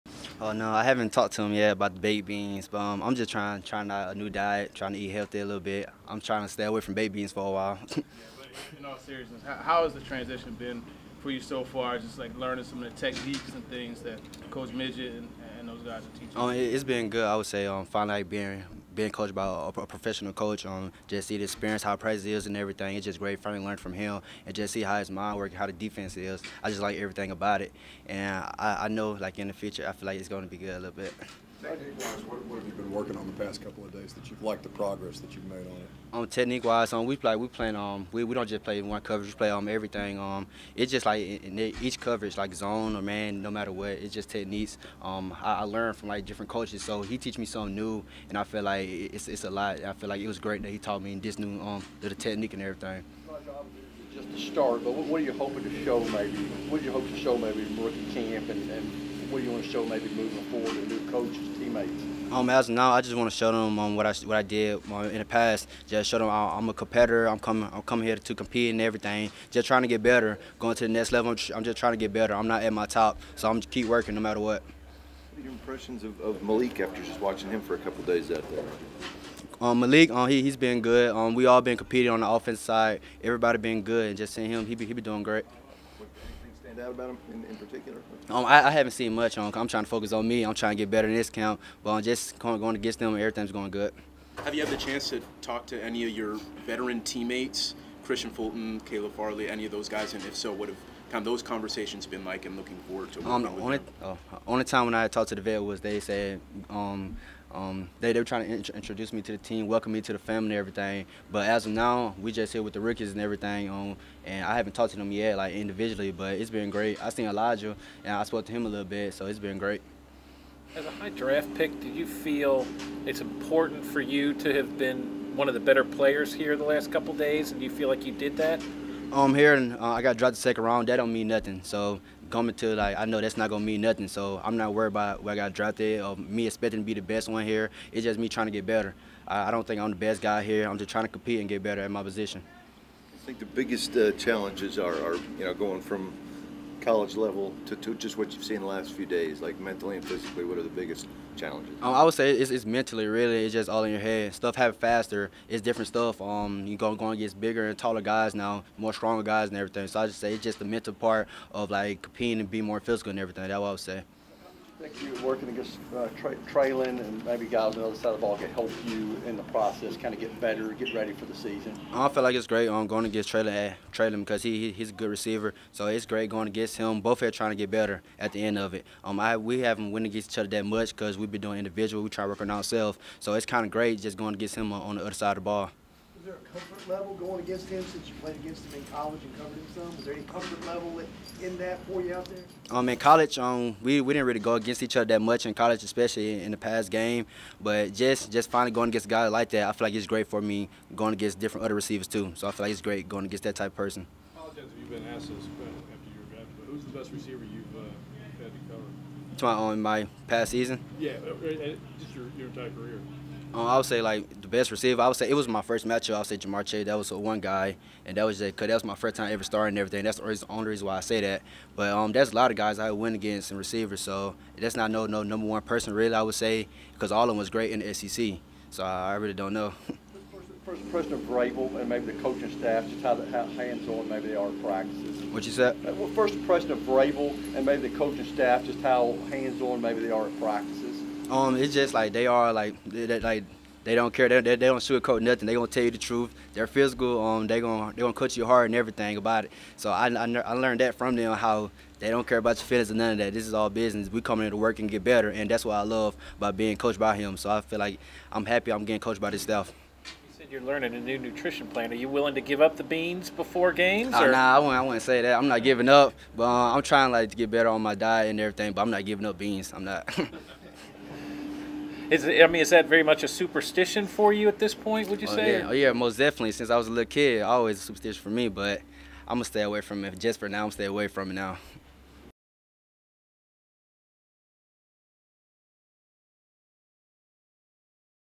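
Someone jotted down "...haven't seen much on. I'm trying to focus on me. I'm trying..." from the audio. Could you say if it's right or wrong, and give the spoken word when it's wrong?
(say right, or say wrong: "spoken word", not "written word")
right.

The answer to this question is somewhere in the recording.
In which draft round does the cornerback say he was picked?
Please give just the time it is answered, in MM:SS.
02:10.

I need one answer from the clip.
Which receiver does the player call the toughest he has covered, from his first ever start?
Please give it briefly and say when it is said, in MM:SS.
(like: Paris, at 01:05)
Ja'Marr Chase, at 03:36.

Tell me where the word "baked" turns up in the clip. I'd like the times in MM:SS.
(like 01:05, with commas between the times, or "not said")
00:01, 00:06.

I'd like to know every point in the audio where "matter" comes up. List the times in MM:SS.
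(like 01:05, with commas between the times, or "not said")
00:43, 01:14.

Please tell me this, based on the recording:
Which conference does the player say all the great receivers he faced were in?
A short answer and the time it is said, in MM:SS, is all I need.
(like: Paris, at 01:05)
SEC, at 03:47.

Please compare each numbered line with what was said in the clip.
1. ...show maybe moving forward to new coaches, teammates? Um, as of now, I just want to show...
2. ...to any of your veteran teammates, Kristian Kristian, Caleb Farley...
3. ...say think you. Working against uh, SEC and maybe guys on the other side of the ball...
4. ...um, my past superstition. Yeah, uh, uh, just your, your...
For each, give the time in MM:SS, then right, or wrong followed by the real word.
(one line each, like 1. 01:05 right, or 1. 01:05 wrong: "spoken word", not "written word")
1. 00:59 right
2. 01:35 wrong: "Fulton", not "Kristian"
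3. 02:43 wrong: "Treylon", not "SEC"
4. 03:29 wrong: "season", not "superstition".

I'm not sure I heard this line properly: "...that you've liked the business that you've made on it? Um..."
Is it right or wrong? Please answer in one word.
wrong.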